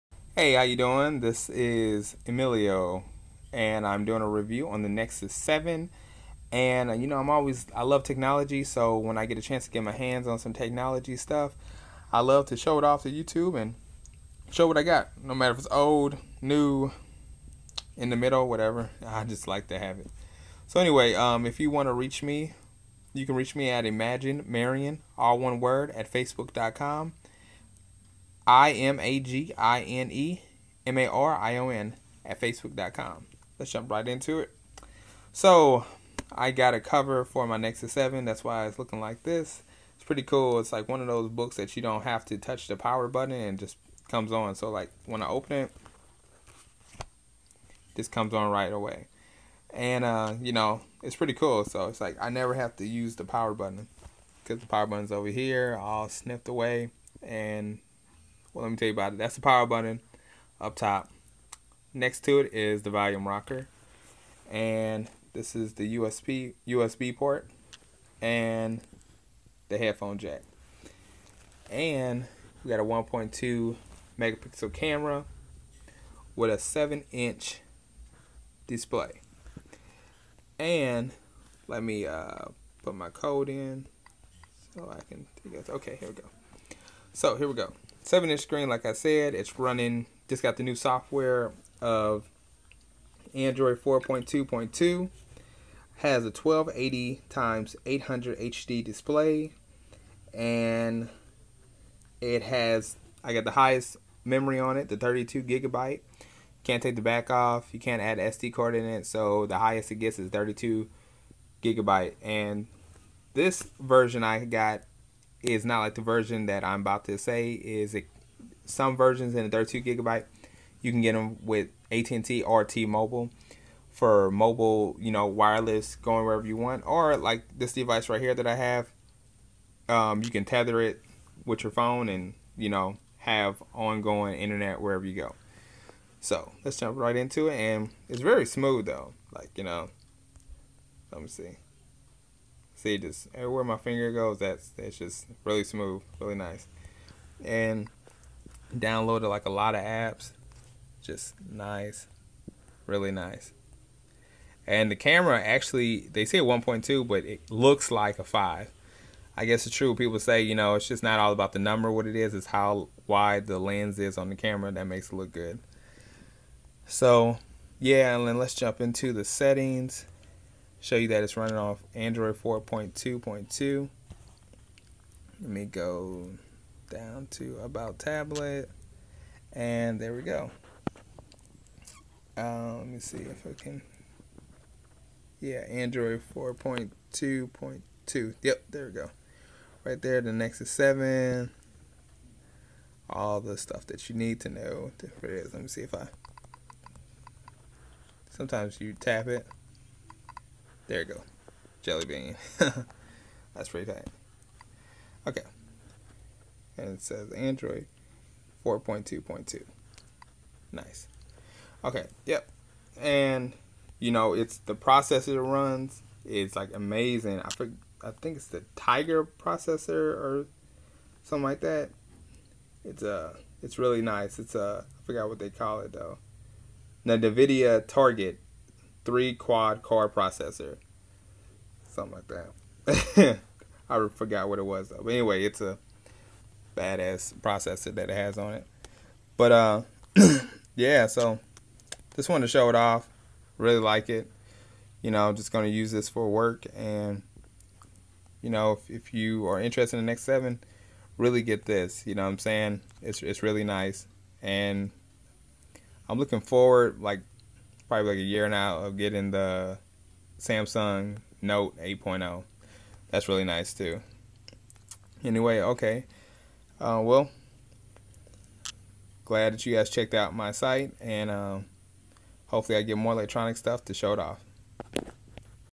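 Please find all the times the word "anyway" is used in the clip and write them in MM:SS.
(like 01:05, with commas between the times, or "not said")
00:20, 03:55, 04:25.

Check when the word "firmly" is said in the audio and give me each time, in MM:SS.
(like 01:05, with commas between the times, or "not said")
not said.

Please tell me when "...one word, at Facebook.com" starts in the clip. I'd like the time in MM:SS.
00:25.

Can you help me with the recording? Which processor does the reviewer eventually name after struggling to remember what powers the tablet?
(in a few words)
Nvidia Tegra 3.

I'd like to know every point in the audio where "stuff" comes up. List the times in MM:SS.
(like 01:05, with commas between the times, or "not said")
00:11, 03:13, 04:33.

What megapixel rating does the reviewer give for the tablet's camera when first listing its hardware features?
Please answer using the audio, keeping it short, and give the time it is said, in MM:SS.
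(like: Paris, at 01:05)
1.2, at 01:12.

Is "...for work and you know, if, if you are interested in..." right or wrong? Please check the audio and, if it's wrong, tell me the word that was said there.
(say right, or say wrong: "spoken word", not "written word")
right.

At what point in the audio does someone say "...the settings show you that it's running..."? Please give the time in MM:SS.
02:49.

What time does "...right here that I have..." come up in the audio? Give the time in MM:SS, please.
02:08.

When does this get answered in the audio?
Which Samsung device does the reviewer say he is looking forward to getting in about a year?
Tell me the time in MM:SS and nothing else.
04:20.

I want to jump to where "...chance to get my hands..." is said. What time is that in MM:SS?
00:09.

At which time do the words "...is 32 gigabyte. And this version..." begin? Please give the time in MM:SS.
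01:50.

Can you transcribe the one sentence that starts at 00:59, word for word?
That's the power button up top.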